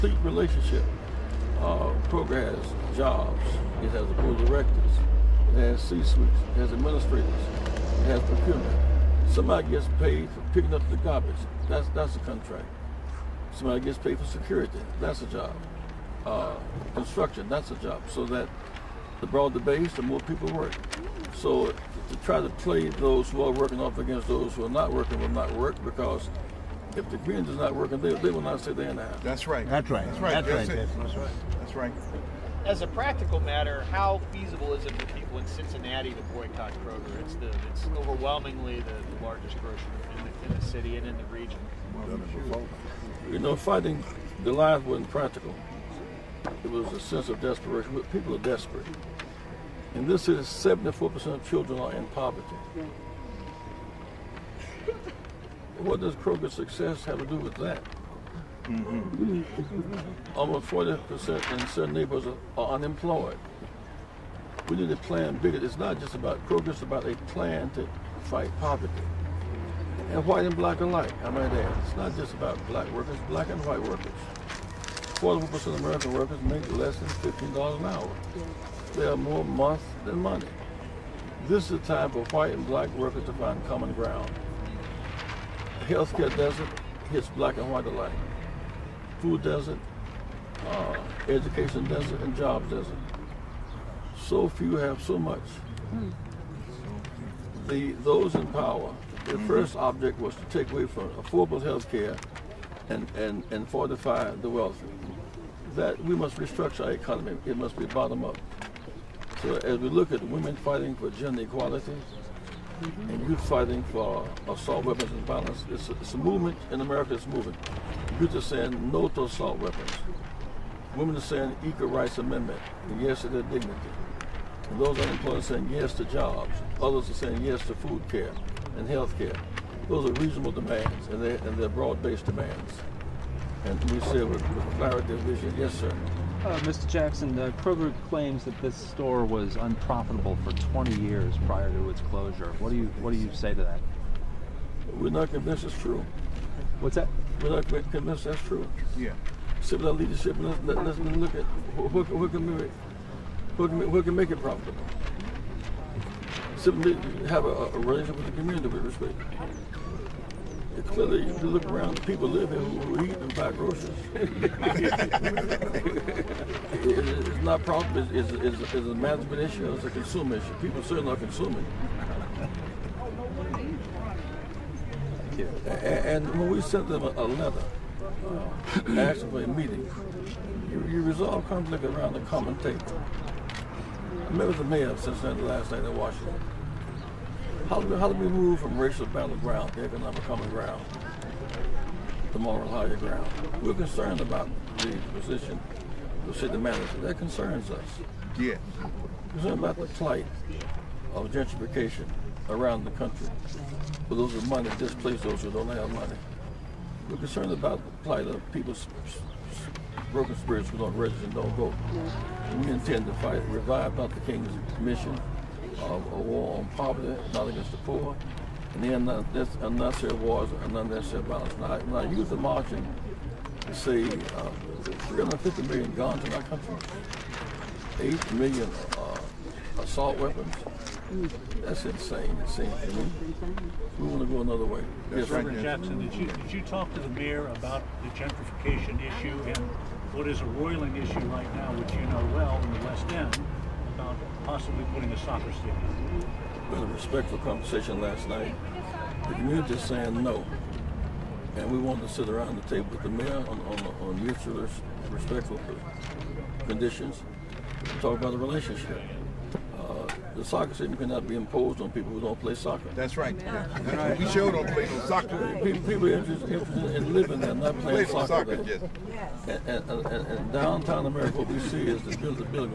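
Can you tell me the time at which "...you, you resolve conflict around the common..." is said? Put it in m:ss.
3:00.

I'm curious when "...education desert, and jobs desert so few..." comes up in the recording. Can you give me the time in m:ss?
1:31.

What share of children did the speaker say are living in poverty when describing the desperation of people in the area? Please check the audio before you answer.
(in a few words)
74%.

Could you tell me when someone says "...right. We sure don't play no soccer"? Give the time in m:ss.
4:23.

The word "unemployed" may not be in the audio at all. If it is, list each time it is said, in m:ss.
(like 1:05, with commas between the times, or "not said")
1:02, 2:04.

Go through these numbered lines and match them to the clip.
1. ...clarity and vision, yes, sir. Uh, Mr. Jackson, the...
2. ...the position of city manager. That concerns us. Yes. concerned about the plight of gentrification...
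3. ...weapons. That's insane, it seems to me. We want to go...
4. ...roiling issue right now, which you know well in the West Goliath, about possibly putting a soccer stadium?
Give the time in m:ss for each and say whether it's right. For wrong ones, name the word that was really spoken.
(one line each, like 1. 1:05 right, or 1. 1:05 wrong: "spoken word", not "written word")
1. 2:14 right
2. 3:14 right
3. 3:50 right
4. 4:00 wrong: "End", not "Goliath".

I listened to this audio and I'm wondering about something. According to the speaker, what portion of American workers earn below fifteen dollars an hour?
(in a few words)
41%.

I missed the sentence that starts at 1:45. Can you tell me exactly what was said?
That we must restructure our economy.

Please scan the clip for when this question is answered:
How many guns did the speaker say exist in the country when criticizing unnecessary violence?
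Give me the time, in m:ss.
3:45.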